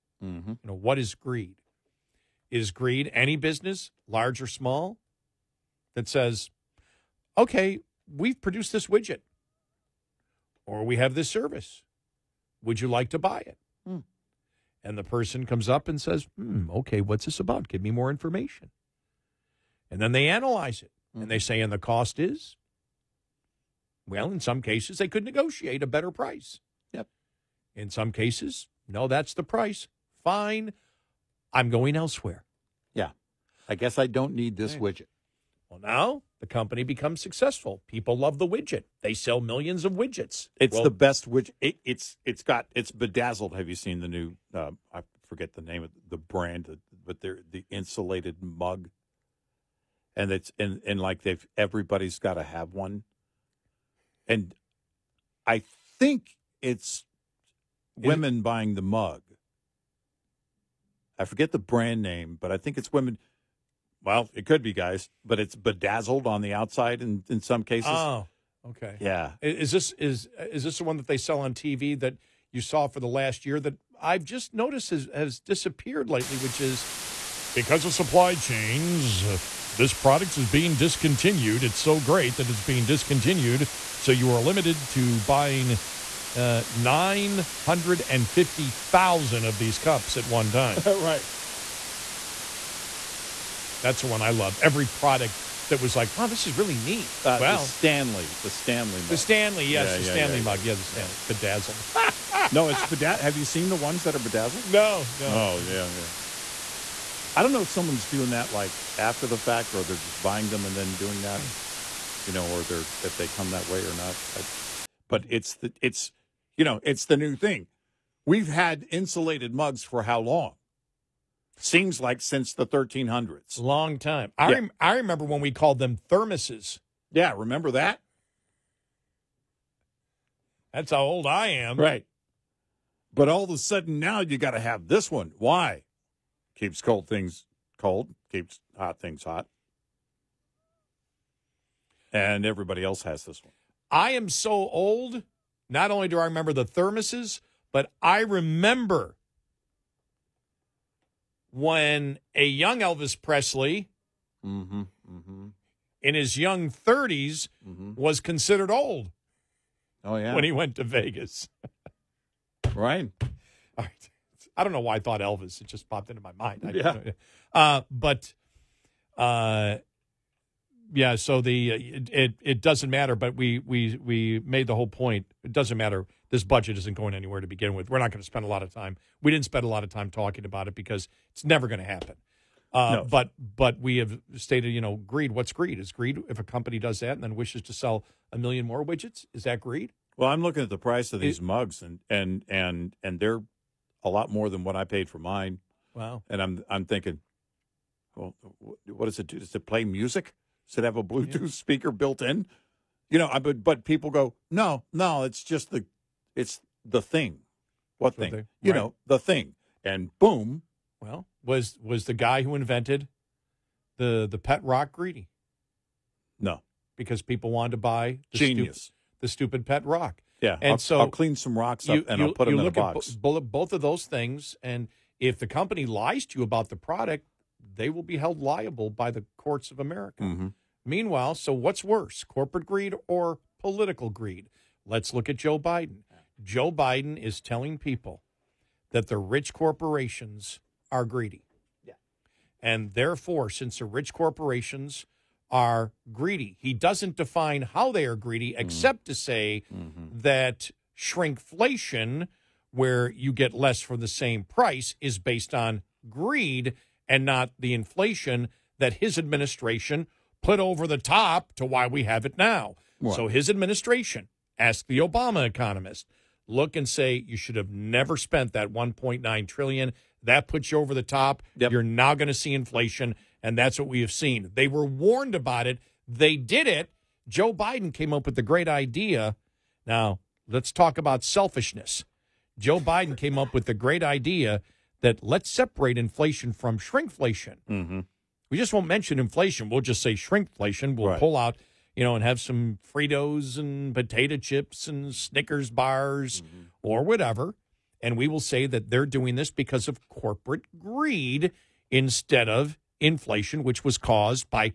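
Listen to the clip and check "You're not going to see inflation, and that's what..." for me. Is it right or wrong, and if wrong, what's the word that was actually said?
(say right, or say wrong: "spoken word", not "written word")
right.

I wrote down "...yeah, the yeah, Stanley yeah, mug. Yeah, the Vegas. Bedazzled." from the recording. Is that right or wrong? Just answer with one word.
wrong.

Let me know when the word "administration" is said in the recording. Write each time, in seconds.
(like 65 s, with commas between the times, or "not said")
259 s, 263 s.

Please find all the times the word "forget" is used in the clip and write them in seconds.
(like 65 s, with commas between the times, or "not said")
45 s, 61 s.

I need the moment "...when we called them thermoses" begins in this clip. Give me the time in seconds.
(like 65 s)
125 s.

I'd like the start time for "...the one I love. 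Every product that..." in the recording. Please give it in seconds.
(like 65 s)
94 s.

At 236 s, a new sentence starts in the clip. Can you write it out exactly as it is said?
Joe Biden is telling people that the rich corporations are greedy.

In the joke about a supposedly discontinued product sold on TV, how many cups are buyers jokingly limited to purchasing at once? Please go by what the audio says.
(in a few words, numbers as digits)
950,000.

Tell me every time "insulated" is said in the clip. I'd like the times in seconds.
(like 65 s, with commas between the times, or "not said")
47 s, 118 s.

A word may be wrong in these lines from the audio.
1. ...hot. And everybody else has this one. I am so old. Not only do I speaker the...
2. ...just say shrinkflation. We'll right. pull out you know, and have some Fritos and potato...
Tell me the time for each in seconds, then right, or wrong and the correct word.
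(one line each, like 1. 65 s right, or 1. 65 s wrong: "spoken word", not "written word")
1. 139 s wrong: "remember", not "speaker"
2. 289 s right.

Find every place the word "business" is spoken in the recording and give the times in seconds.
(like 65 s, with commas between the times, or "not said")
3 s.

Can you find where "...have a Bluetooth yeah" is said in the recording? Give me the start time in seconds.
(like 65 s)
200 s.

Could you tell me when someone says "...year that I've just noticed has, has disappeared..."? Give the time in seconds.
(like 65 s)
73 s.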